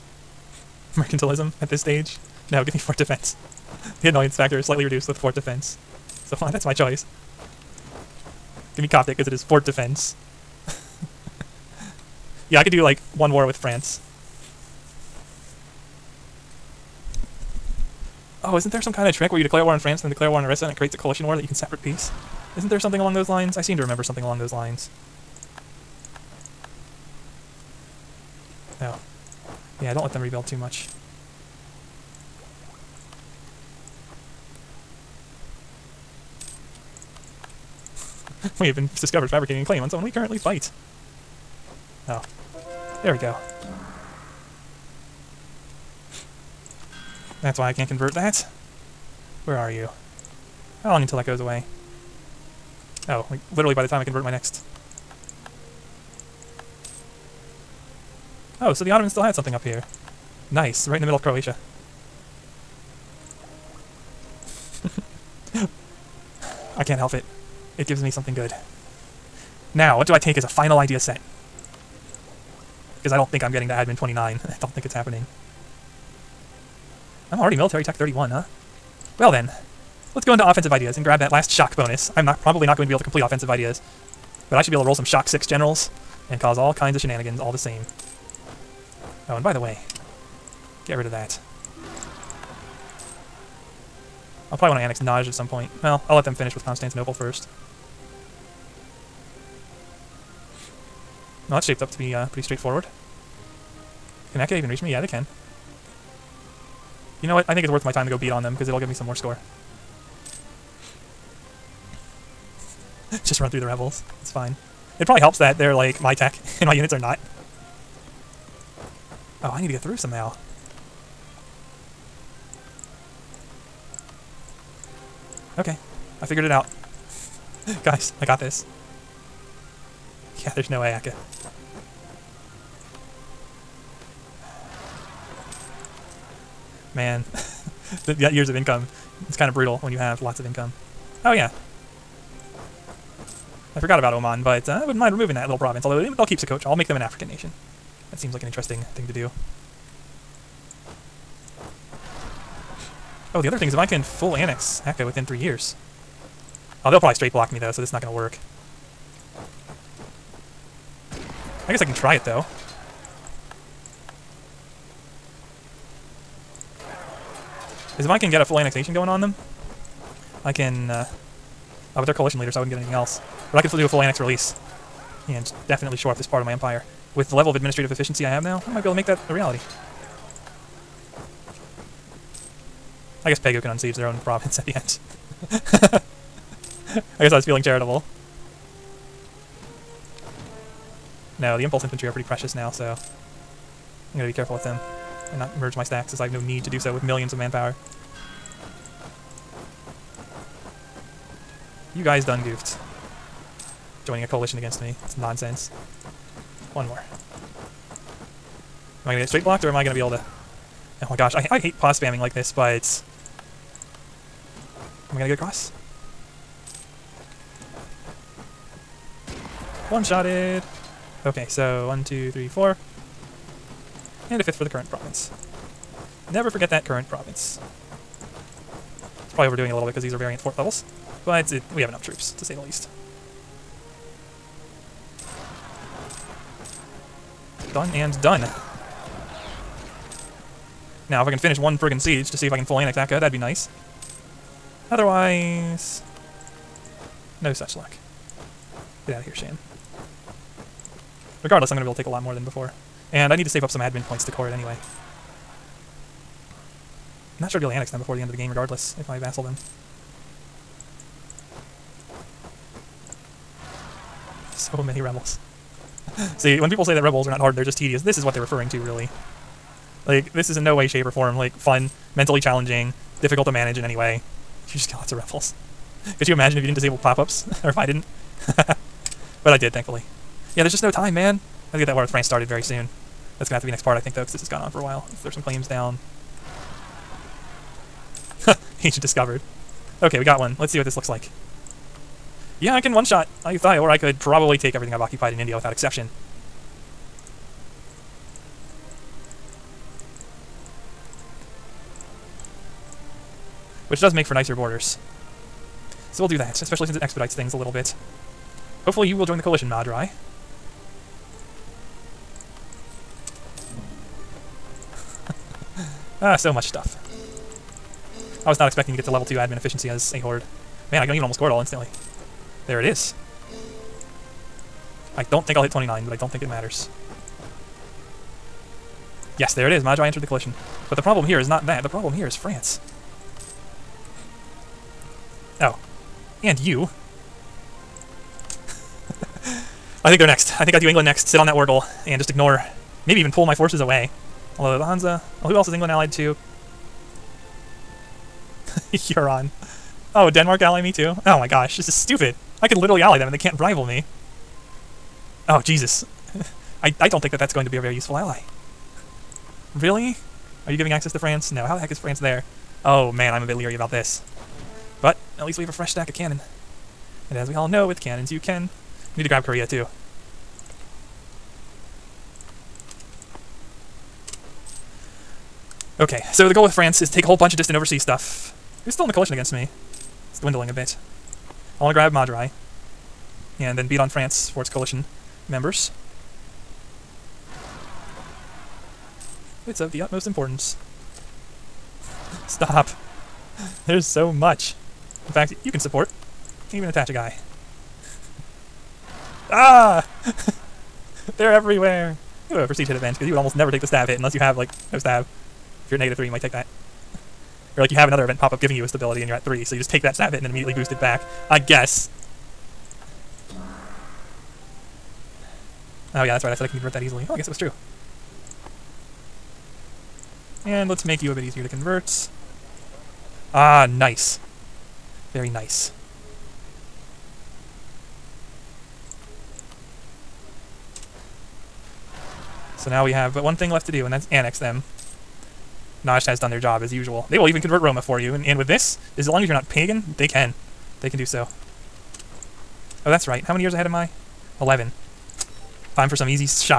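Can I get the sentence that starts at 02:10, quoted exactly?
Yeah, there's no way I could.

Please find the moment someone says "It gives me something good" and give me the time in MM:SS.
01:07.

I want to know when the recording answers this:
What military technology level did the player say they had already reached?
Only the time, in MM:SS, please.
01:17.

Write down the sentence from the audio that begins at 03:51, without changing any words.
But it, we have enough troops, to say the least.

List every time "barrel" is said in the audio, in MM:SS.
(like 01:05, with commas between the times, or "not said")
not said.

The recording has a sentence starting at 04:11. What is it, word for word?
Regardless, I'm going to be able to take a lot more than before.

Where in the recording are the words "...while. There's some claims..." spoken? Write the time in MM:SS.
04:44.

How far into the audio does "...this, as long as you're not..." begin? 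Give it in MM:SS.
07:18.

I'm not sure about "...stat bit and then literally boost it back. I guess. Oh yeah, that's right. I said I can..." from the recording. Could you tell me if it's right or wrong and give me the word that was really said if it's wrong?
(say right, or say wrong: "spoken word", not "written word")
wrong: "immediately", not "literally".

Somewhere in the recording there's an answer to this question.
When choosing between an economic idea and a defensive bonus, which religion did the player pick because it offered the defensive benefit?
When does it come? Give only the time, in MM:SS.
00:08.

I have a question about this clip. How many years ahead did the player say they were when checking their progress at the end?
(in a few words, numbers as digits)
11.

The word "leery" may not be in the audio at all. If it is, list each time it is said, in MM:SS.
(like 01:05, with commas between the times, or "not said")
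06:03.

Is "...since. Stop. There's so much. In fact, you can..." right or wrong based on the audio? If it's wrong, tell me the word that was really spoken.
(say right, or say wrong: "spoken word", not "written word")
wrong: "importance", not "since".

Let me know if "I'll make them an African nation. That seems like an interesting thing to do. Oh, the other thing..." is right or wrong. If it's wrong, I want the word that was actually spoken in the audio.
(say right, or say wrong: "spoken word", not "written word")
right.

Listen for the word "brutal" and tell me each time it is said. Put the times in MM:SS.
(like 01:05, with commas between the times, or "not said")
02:19.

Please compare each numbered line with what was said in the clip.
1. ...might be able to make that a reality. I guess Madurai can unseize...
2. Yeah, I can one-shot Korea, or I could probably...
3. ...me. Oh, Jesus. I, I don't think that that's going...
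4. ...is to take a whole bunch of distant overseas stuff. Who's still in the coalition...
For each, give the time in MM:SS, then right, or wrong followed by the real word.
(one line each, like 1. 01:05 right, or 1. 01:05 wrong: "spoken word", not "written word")
1. 02:58 wrong: "Pegu", not "Madurai"
2. 04:52 wrong: "Ayutthaya", not "Korea"
3. 05:53 right
4. 06:16 right.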